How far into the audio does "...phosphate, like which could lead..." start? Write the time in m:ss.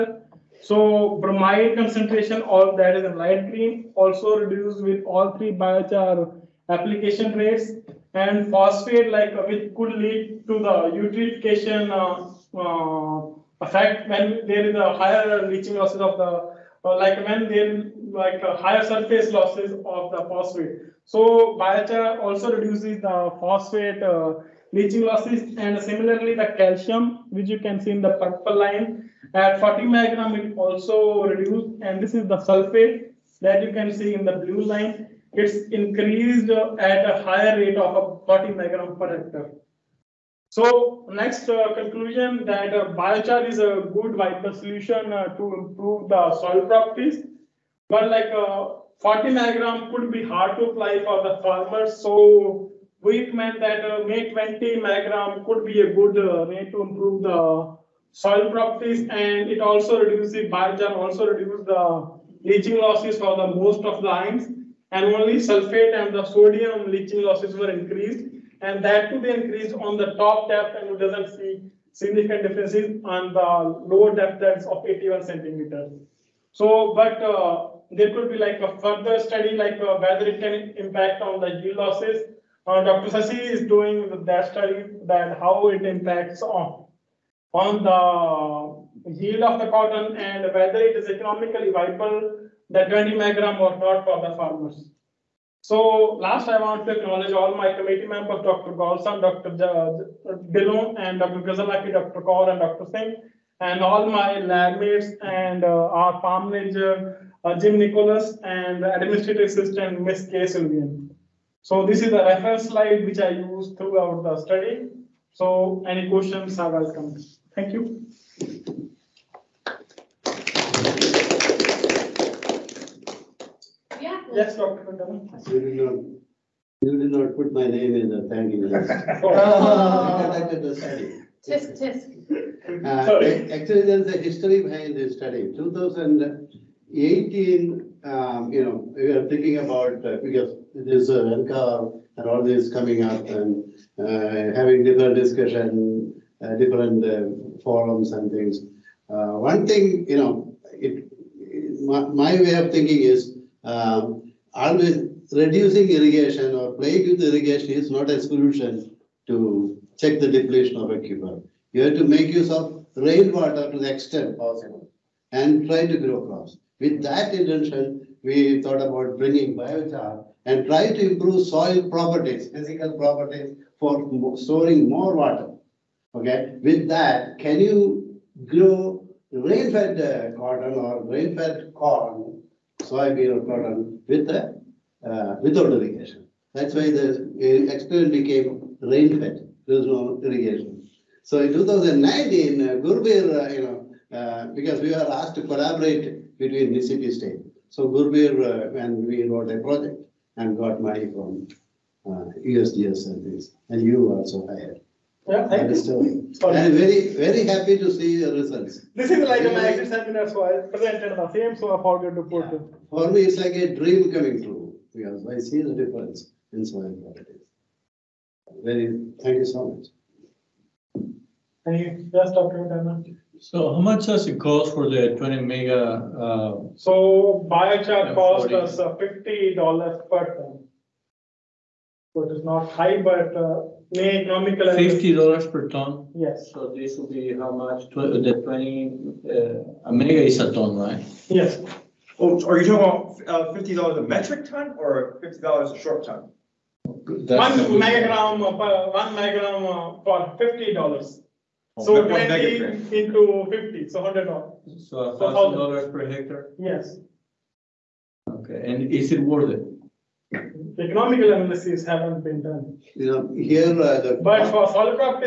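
0:08.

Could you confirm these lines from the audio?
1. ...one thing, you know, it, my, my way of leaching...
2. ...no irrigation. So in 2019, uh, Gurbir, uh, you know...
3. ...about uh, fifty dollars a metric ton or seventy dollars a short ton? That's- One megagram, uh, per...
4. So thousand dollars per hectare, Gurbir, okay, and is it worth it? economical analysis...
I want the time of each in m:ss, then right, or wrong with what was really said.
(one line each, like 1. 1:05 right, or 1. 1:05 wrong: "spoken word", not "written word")
1. 2:29 wrong: "thinking", not "leaching"
2. 3:09 right
3. 4:03 wrong: "fifty", not "seventy"
4. 4:14 wrong: "Yes", not "Gurbir".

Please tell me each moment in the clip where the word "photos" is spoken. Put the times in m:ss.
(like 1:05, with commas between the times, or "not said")
not said.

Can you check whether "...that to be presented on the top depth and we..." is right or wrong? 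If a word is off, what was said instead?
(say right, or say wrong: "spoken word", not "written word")
wrong: "increased", not "presented".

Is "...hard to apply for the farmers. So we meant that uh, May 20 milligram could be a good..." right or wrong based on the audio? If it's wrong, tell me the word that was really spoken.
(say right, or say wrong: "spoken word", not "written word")
right.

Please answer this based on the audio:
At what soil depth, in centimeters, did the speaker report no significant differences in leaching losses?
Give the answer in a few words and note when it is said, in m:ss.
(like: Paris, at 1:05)
81, at 1:14.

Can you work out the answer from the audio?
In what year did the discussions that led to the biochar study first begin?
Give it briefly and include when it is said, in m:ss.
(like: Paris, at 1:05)
2018, at 2:15.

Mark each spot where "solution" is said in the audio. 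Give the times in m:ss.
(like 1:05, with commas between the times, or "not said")
0:44, 2:38.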